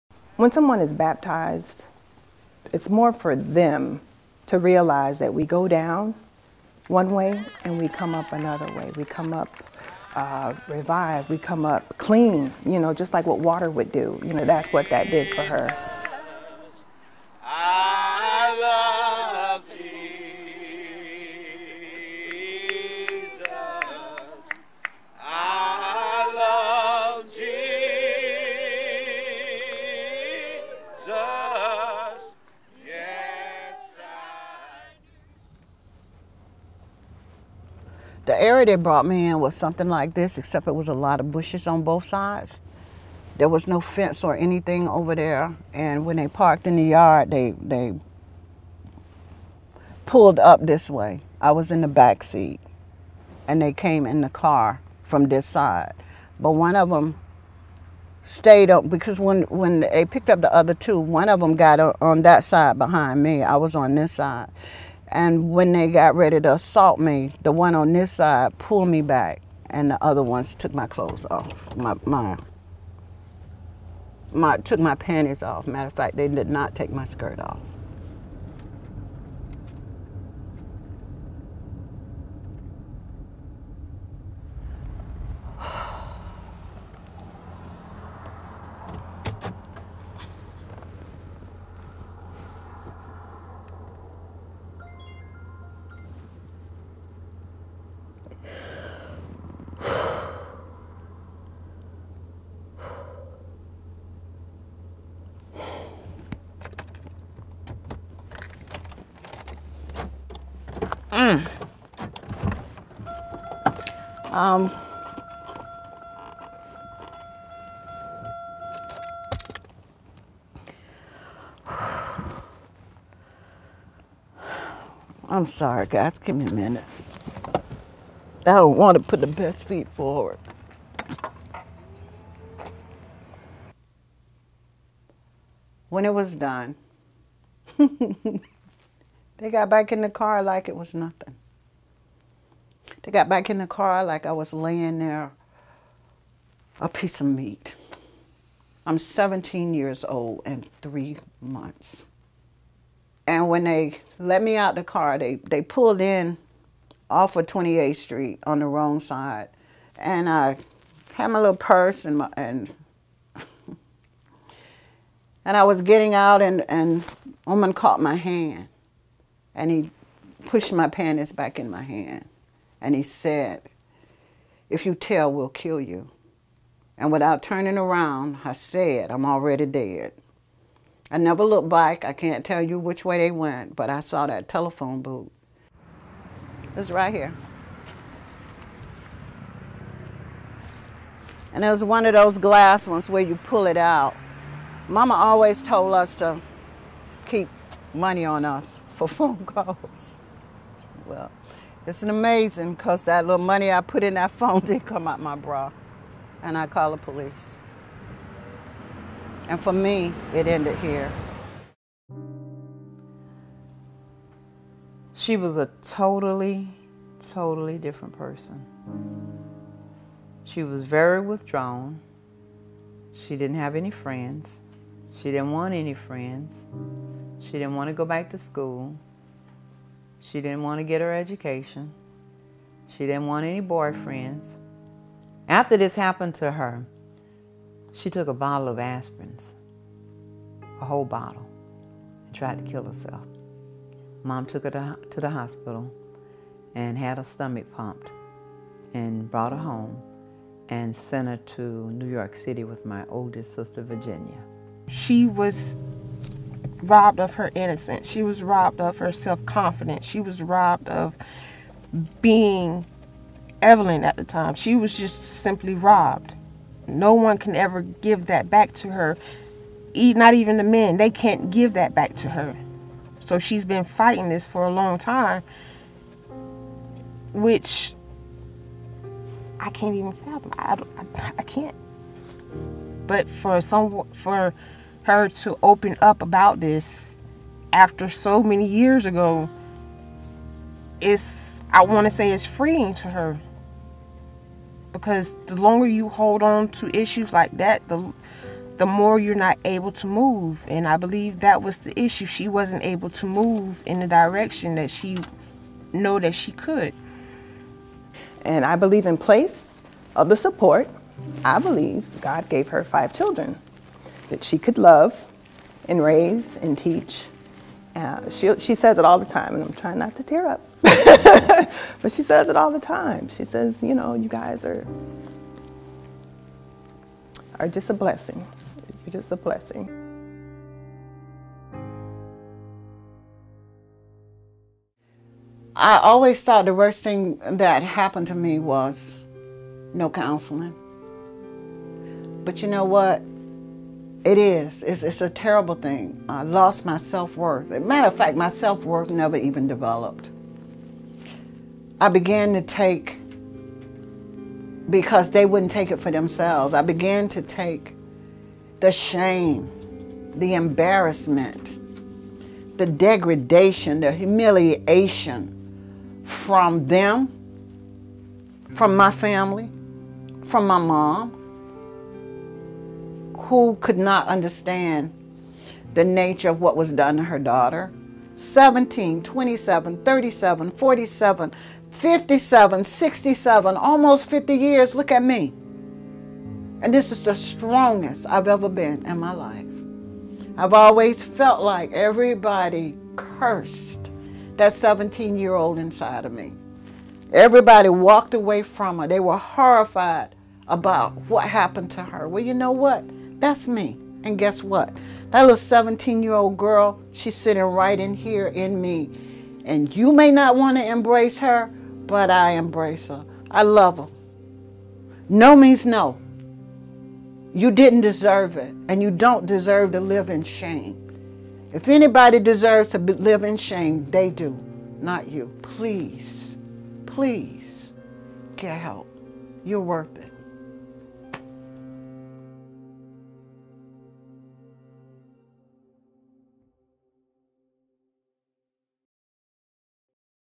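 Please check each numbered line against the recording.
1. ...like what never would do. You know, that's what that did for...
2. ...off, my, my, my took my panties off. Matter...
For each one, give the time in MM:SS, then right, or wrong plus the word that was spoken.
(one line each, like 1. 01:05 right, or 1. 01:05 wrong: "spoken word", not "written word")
1. 00:13 wrong: "water", not "never"
2. 01:11 right.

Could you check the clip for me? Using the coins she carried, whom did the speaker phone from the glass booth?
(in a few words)
The police.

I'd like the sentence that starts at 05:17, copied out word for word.
Uh, she, she says it all the time, and I'm trying not to tear up.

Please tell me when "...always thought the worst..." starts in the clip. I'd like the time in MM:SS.
05:35.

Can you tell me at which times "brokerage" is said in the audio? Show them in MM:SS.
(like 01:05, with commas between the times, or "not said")
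not said.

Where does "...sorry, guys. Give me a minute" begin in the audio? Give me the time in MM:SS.
02:05.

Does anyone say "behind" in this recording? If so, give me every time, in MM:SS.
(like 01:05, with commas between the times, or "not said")
01:02.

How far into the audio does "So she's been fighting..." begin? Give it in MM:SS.
04:33.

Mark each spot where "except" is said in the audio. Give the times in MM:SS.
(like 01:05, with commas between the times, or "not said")
00:40.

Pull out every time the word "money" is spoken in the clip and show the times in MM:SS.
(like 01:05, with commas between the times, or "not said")
03:17, 03:23.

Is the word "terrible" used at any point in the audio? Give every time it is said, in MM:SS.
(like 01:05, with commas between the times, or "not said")
05:45.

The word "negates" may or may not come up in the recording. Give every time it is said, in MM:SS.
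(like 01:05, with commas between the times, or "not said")
not said.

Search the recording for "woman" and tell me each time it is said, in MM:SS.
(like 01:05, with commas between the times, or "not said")
02:47.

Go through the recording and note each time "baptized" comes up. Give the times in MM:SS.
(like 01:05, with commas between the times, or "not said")
00:00.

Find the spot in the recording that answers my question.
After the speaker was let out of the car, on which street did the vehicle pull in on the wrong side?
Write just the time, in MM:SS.
02:37.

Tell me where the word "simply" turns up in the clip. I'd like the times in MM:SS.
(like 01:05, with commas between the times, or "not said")
04:25.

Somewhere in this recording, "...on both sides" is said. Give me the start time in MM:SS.
00:41.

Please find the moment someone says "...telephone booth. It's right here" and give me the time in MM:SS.
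03:04.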